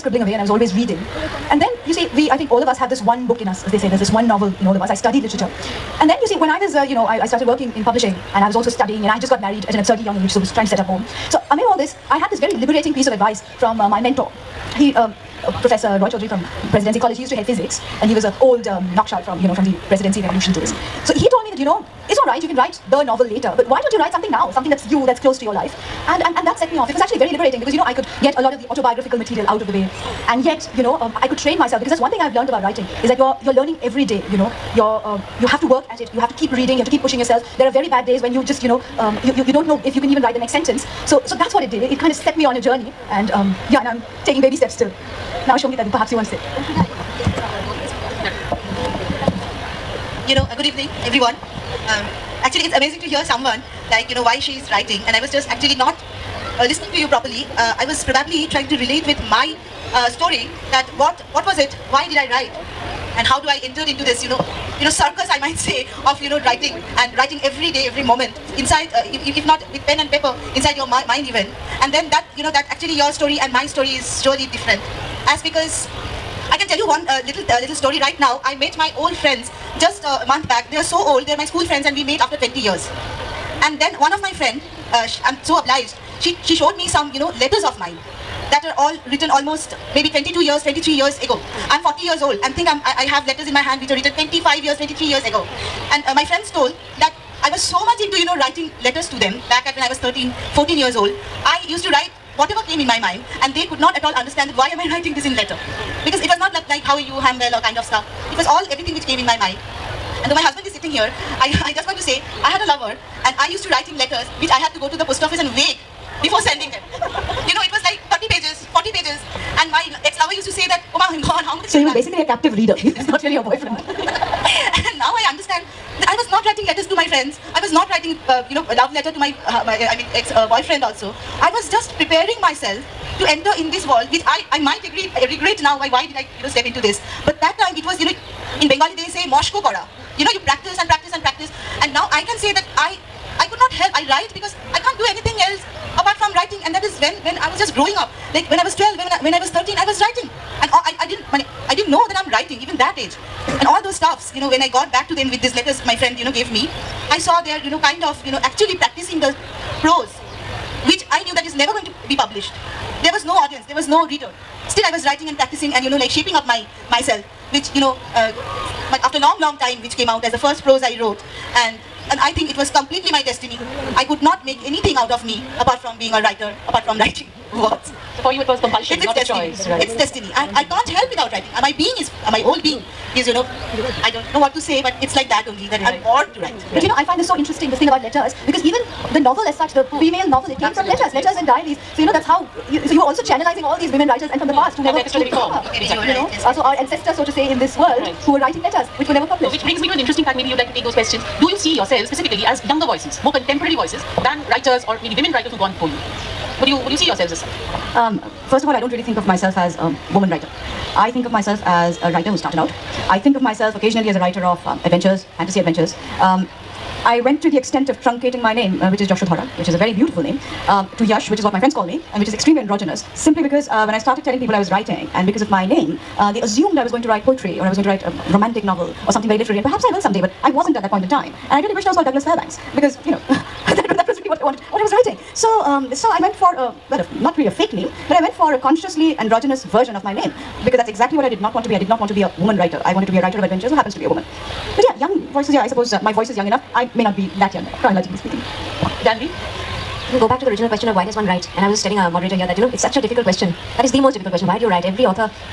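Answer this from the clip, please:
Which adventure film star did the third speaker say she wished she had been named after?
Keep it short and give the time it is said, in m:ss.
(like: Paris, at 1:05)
Douglas Fairbanks, at 3:52.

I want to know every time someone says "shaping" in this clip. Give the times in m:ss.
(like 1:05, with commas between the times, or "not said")
2:46.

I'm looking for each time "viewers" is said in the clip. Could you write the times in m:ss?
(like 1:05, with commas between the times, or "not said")
not said.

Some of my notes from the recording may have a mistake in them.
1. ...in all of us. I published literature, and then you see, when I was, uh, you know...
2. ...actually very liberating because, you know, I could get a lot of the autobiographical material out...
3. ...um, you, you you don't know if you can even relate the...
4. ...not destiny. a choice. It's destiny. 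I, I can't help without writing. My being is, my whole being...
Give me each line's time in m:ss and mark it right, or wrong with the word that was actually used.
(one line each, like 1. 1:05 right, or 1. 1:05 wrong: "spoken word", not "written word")
1. 0:04 wrong: "studied", not "published"
2. 0:26 right
3. 0:38 wrong: "write", not "relate"
4. 2:59 right.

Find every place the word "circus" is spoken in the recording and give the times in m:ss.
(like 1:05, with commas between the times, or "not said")
1:04.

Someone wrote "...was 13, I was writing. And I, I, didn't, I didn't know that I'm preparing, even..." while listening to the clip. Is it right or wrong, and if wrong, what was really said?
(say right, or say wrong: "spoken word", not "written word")
wrong: "writing", not "preparing".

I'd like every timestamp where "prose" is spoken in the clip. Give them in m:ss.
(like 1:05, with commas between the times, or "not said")
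2:39, 2:50.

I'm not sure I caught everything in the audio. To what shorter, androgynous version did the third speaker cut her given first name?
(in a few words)
Yash.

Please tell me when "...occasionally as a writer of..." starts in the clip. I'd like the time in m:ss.
3:33.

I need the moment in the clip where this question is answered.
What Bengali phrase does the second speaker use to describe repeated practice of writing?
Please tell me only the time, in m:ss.
2:19.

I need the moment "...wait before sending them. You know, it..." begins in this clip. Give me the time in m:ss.
1:55.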